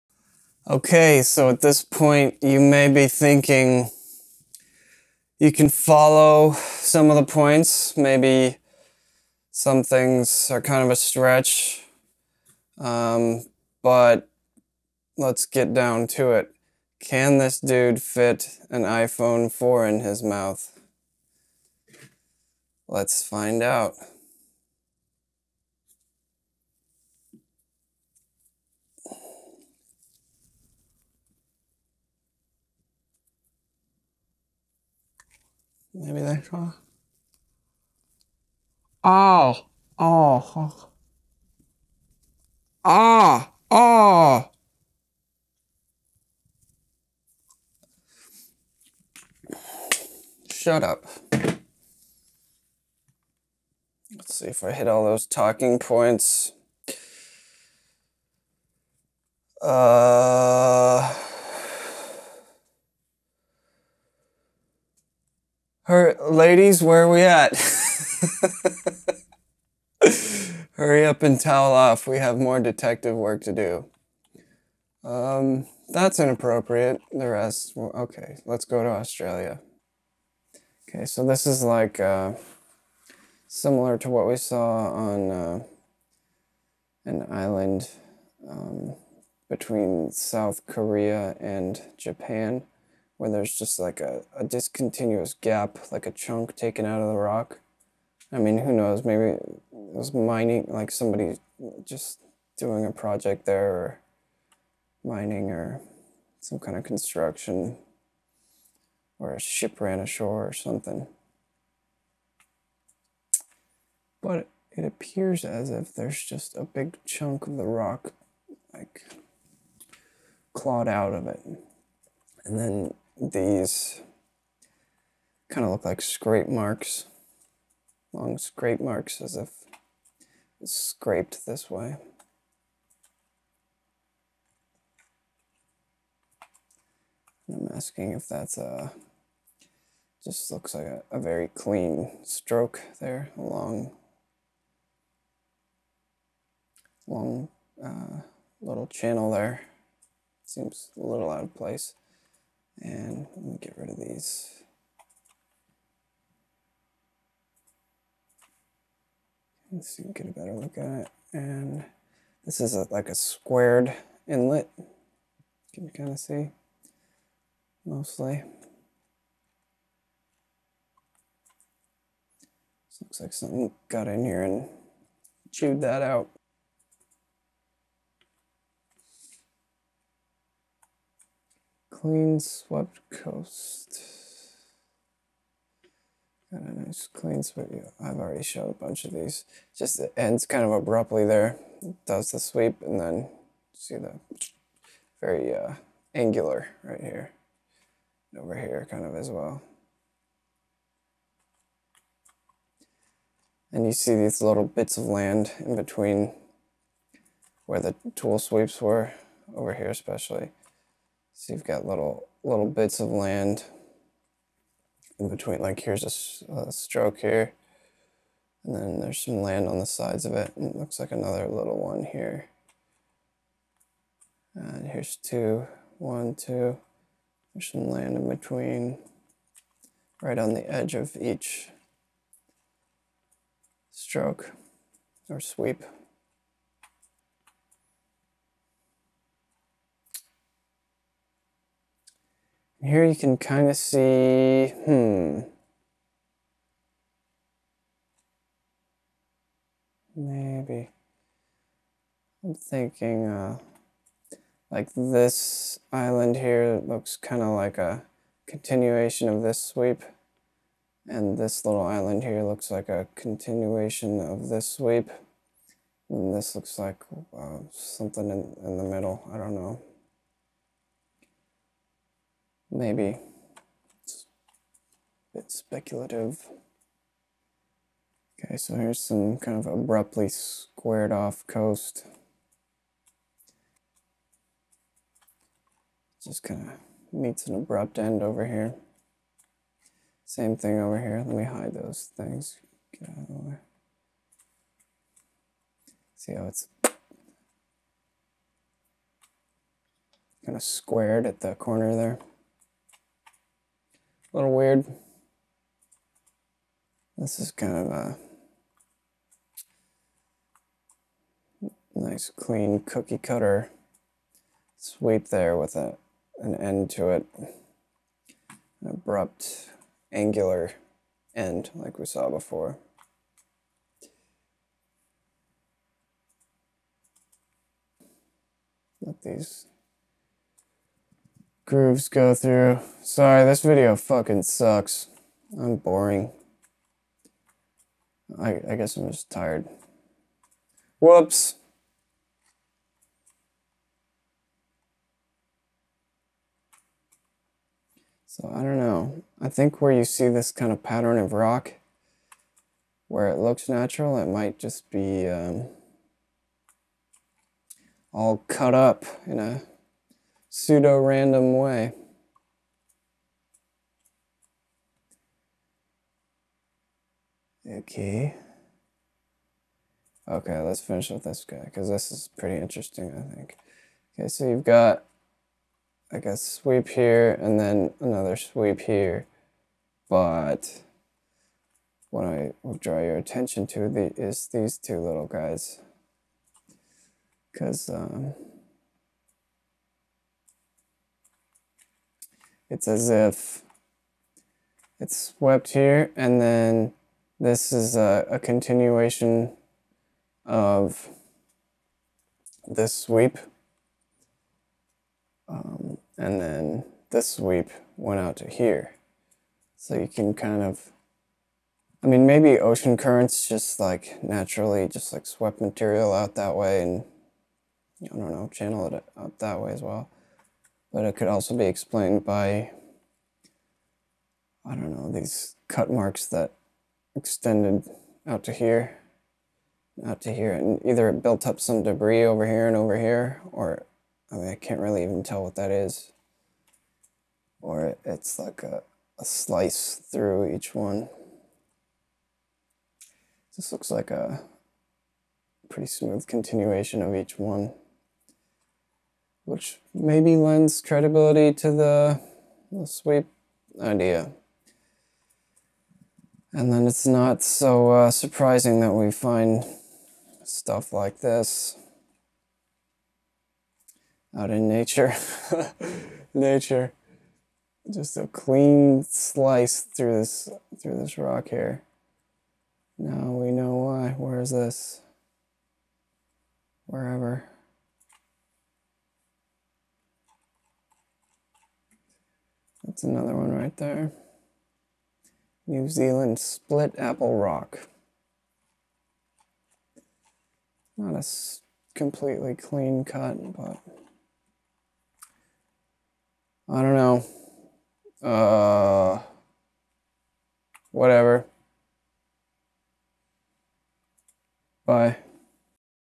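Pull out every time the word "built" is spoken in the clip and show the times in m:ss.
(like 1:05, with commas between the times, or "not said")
7:11.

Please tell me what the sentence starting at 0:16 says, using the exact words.
Can this dude fit an iPhone 4 in his mouth?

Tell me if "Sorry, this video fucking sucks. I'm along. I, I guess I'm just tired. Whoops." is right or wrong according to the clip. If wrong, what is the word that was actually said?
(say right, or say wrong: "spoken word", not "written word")
wrong: "boring", not "along".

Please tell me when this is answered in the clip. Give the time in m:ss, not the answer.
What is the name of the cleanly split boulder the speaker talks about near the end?
8:06.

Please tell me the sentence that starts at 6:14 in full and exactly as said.
Okay, so you've got like a sweep here and then another sweep here.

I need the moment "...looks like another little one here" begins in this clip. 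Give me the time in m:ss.
3:40.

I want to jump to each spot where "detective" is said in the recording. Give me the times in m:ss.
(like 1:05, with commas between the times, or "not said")
1:12.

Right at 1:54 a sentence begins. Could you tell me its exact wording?
But it appears as if there's just a big chunk of the rock, like clawed out of it.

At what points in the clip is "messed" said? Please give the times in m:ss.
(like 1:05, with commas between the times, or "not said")
not said.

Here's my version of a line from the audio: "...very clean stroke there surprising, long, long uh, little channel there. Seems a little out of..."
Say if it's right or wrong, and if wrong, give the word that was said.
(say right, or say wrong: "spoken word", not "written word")
wrong: "along", not "surprising".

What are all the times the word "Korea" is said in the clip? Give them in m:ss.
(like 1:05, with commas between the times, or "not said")
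1:30.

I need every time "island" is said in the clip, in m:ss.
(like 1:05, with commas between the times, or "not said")
1:27, 4:15, 4:21.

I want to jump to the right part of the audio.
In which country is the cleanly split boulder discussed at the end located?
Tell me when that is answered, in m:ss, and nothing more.
8:05.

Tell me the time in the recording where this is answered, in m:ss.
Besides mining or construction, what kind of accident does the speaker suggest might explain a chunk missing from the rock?
1:49.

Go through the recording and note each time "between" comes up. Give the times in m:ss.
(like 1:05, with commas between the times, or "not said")
1:29, 3:25, 3:35, 3:48.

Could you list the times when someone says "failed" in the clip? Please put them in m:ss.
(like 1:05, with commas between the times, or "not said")
not said.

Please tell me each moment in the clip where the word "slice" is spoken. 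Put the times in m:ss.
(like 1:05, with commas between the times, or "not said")
7:19, 7:49.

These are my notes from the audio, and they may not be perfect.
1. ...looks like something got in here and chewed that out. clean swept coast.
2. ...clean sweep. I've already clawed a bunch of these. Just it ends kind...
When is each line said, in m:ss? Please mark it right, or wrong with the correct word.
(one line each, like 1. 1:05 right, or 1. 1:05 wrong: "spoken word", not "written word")
1. 2:53 right
2. 3:07 wrong: "showed", not "clawed".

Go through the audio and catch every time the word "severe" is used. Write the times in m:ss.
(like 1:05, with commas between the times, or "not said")
not said.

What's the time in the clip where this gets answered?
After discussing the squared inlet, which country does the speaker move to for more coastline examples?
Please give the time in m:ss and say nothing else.
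1:18.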